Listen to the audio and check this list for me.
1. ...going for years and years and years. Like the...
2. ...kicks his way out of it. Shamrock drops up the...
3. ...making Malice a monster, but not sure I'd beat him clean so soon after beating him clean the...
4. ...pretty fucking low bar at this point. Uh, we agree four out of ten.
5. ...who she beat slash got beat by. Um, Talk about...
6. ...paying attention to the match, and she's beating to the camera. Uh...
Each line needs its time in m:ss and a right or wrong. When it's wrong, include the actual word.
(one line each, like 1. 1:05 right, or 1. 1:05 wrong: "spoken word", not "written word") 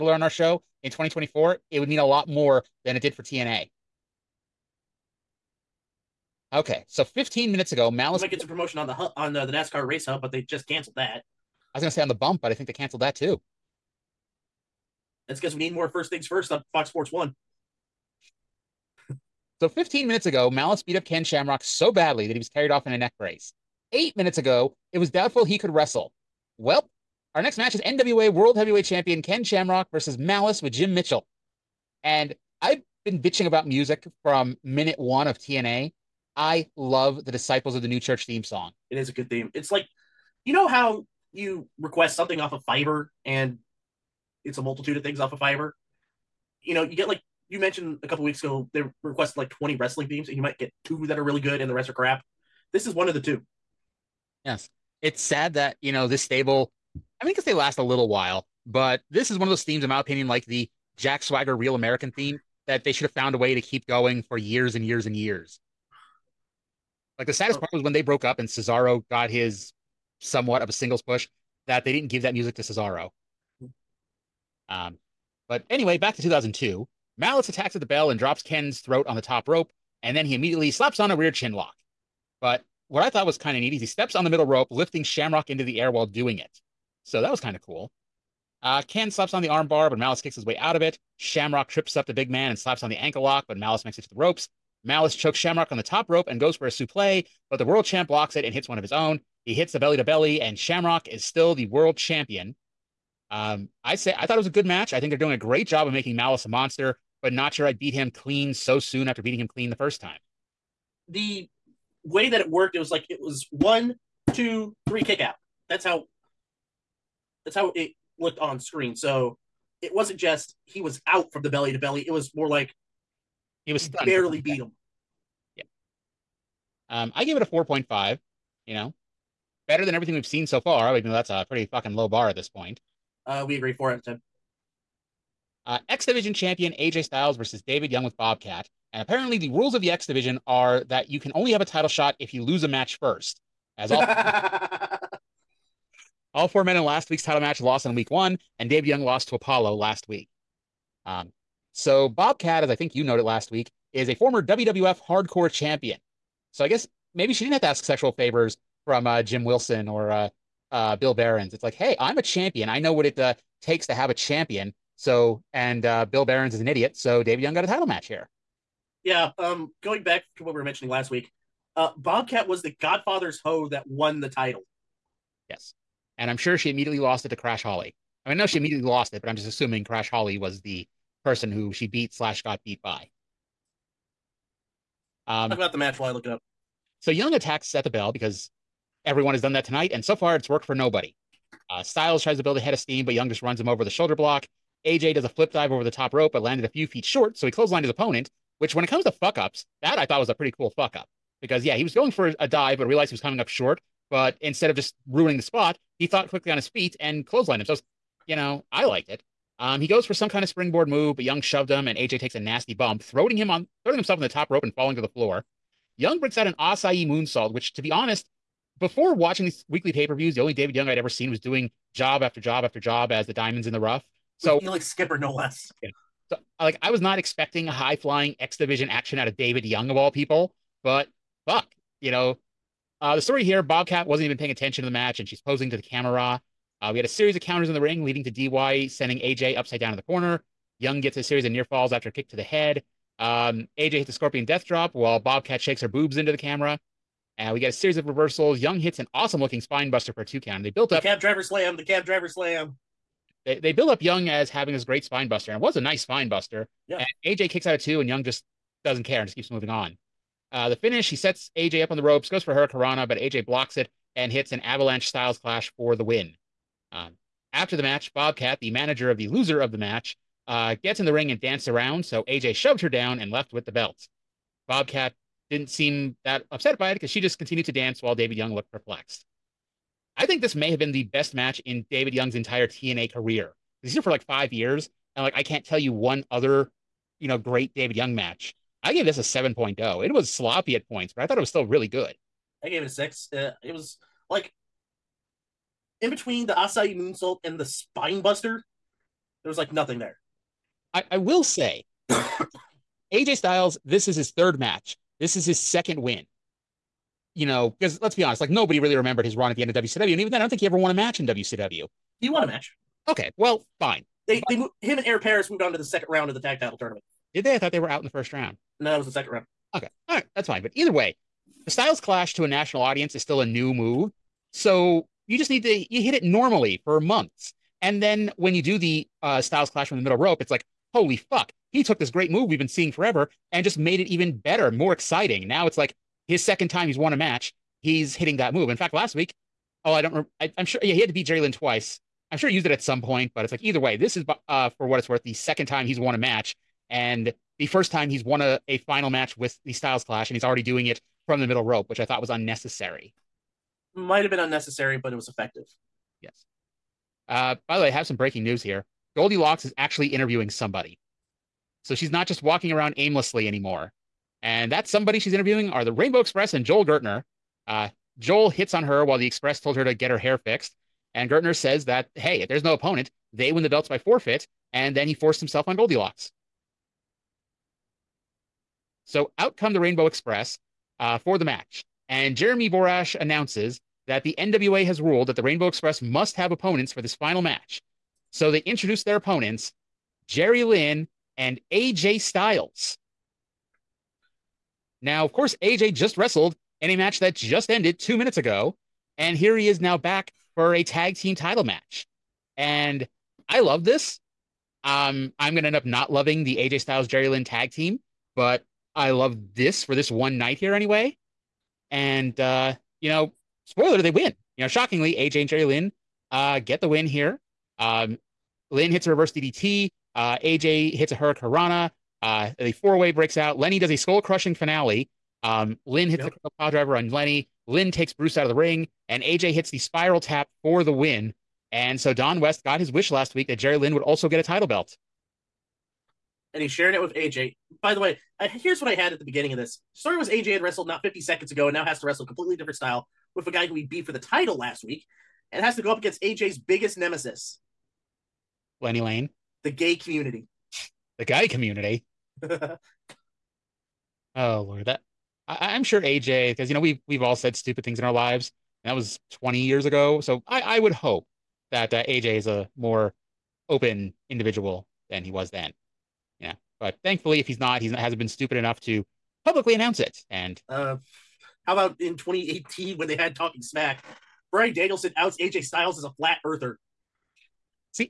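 1. 1:03 right
2. 1:30 wrong: "trips", not "drops"
3. 1:45 right
4. 2:11 right
5. 3:01 right
6. 3:54 wrong: "posing", not "beating".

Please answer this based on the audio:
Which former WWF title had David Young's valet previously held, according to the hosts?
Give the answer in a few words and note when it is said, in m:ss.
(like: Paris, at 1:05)
Hardcore Champion, at 2:35.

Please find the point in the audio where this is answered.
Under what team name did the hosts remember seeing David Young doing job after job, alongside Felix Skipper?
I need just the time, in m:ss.
3:43.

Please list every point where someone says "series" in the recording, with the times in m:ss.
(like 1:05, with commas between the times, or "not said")
3:57, 4:01, 4:07.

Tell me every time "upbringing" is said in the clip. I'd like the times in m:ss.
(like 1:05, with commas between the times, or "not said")
not said.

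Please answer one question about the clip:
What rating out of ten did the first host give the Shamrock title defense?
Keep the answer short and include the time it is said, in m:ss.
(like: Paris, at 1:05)
4.5, at 2:07.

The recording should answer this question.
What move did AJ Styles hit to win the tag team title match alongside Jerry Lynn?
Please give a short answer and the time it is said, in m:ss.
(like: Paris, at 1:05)
spiral tap, at 7:09.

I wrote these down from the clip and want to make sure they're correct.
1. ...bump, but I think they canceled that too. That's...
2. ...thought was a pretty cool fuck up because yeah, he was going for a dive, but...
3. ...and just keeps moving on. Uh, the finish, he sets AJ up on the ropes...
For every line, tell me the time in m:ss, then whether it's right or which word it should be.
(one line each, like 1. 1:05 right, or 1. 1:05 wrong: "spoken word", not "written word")
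1. 0:12 right
2. 3:20 right
3. 4:19 right.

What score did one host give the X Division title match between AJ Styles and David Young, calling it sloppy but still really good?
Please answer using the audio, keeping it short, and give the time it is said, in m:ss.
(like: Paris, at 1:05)
7.0, at 4:49.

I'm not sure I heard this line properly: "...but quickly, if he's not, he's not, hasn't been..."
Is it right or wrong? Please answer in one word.
wrong.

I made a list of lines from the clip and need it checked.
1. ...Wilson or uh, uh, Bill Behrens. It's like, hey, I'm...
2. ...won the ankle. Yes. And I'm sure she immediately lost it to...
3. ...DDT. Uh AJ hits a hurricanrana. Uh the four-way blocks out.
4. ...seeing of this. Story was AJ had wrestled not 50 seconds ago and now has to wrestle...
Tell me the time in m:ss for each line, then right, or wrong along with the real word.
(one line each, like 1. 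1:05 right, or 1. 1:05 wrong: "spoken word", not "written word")
1. 2:39 right
2. 2:53 wrong: "title", not "ankle"
3. 6:59 wrong: "breaks", not "blocks"
4. 7:19 wrong: "beginning", not "seeing".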